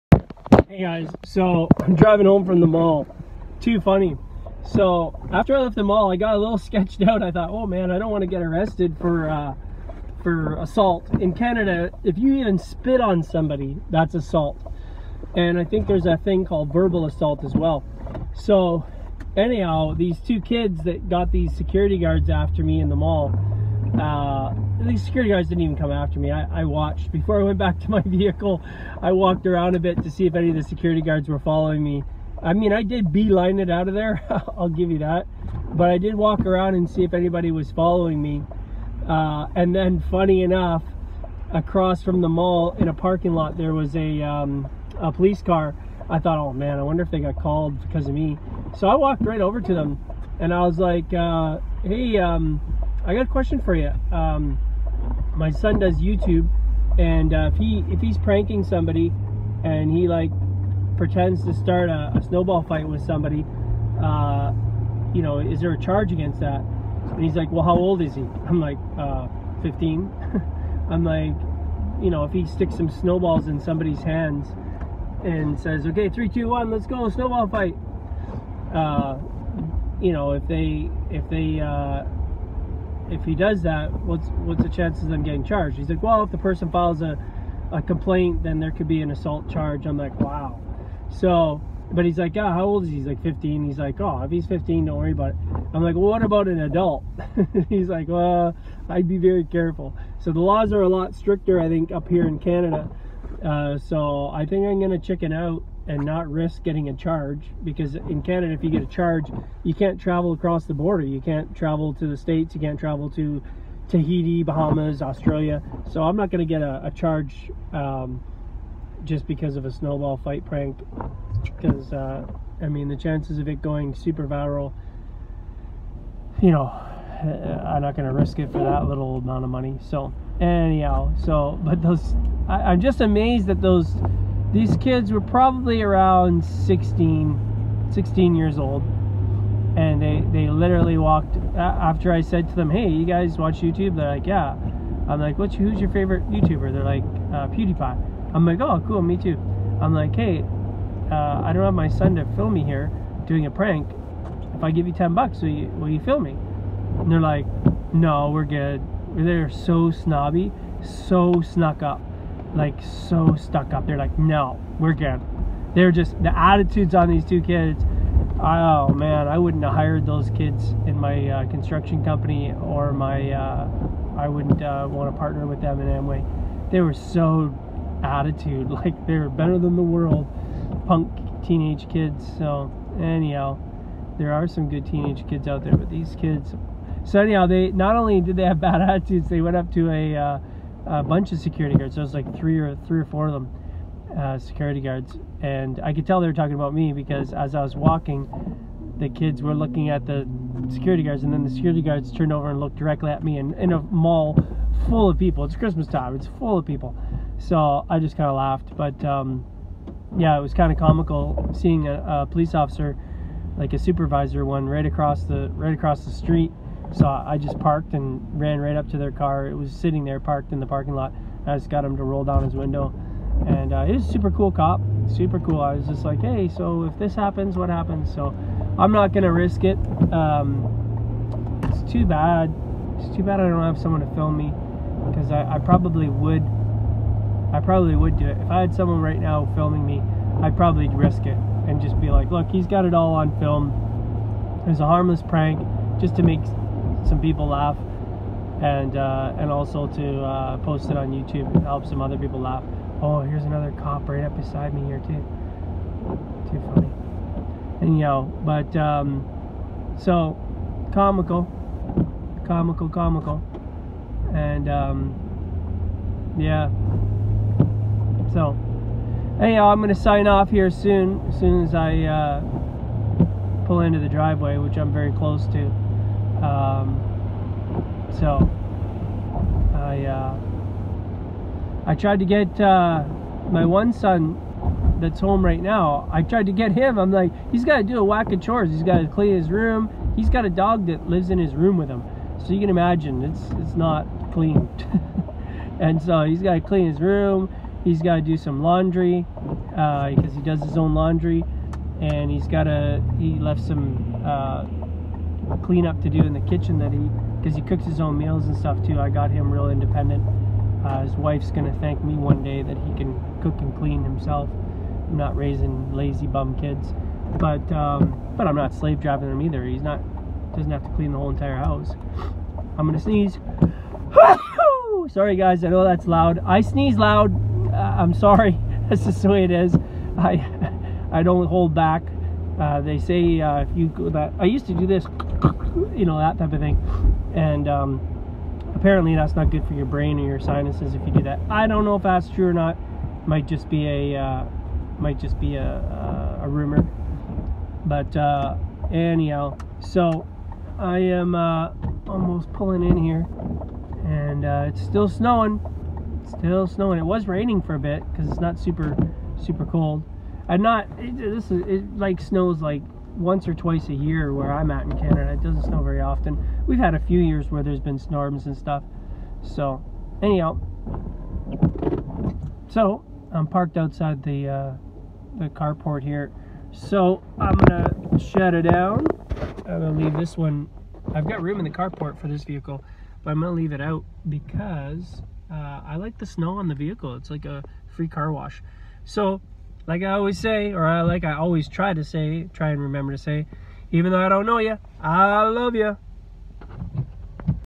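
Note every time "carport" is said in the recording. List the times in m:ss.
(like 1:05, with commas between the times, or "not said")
6:15, 6:21.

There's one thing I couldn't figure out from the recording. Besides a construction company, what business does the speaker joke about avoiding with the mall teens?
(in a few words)
Amway.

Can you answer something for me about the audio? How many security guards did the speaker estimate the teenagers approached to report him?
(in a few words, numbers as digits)
3 or 4.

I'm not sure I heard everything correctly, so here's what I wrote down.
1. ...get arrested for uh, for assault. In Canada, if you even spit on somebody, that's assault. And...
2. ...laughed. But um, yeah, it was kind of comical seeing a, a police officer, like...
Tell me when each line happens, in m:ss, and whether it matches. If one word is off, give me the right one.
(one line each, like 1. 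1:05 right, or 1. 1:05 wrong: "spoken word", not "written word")
1. 0:08 right
2. 3:28 right.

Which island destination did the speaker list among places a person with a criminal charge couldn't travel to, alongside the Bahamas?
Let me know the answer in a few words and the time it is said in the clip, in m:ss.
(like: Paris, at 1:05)
Tahiti, at 1:53.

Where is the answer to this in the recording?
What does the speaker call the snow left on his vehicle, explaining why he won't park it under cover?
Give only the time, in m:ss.
6:27.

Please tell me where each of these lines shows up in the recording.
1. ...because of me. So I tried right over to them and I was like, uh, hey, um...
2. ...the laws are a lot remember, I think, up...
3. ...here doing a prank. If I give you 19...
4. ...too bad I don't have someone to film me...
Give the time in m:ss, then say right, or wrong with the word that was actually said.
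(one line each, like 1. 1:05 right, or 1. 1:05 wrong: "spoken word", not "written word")
1. 0:47 wrong: "walked", not "tried"
2. 1:40 wrong: "stricter", not "remember"
3. 2:32 wrong: "10", not "19"
4. 3:53 right.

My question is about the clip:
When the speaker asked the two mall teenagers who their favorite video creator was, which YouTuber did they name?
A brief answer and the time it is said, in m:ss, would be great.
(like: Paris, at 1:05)
PewDiePie, at 2:27.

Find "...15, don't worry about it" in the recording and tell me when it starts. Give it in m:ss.
1:34.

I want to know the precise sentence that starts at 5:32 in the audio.
Uh, they say uh, if you go that I used to do this you know, that type of thing.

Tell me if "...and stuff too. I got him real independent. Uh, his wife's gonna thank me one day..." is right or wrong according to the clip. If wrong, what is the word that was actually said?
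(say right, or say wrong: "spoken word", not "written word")
right.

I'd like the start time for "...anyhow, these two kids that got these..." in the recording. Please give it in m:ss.
0:19.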